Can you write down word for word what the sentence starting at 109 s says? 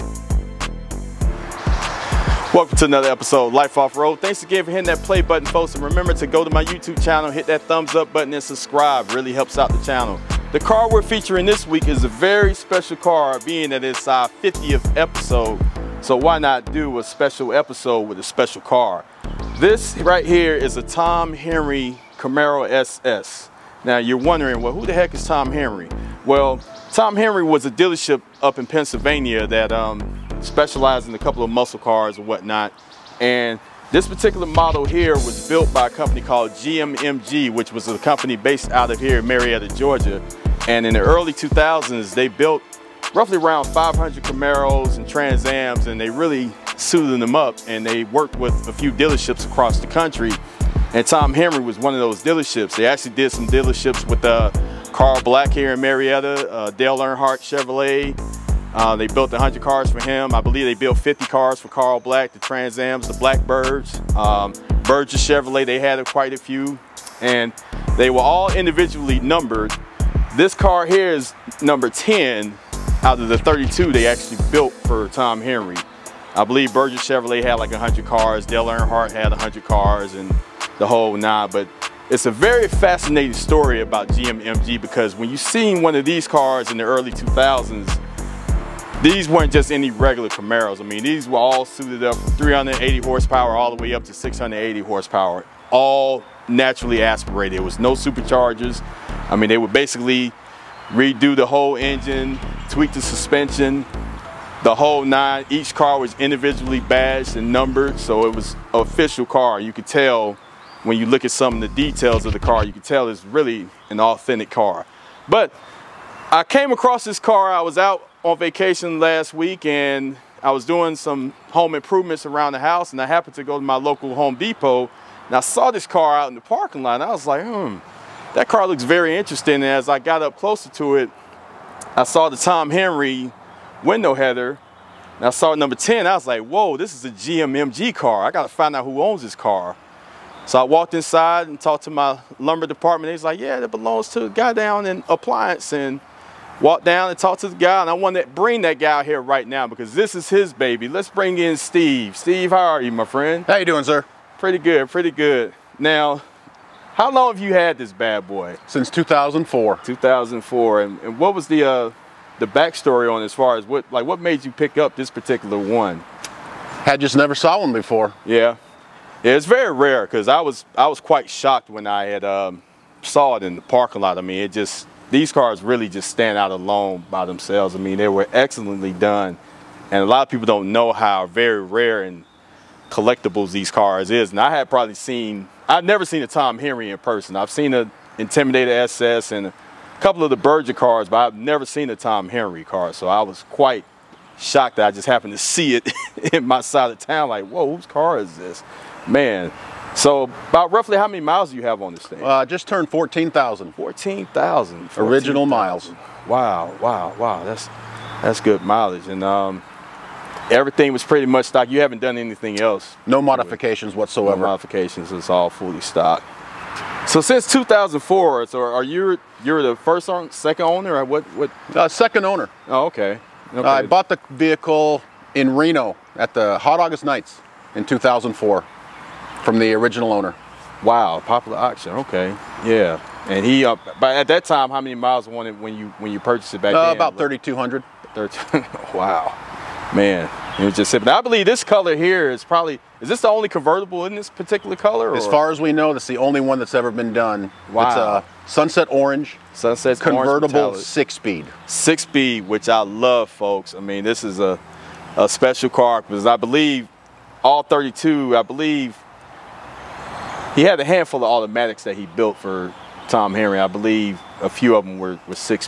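You could tell when you look at some of the details of the car, you can tell it's really an authentic car.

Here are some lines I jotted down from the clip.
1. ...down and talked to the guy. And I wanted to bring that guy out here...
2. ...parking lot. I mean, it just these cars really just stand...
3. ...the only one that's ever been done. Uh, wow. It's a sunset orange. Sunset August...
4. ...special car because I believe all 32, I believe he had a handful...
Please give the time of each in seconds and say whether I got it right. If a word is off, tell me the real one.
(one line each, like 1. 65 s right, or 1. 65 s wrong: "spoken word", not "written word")
1. 146 s right
2. 173 s right
3. 246 s wrong: "Convertible", not "August"
4. 255 s right.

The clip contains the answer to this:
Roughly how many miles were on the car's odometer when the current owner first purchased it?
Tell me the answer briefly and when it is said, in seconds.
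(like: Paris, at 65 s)
3,200, at 237 s.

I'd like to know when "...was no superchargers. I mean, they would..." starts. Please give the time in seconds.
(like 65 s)
97 s.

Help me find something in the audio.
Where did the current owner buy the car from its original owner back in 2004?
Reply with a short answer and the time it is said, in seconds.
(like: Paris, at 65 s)
Reno, at 225 s.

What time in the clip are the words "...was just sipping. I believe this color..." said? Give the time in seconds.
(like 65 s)
240 s.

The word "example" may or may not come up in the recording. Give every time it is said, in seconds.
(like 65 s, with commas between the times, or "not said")
not said.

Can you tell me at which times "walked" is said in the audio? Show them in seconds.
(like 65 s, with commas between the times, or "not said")
140 s, 146 s.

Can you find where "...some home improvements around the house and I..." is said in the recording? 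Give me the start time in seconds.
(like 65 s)
120 s.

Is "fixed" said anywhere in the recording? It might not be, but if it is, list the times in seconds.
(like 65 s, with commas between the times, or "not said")
not said.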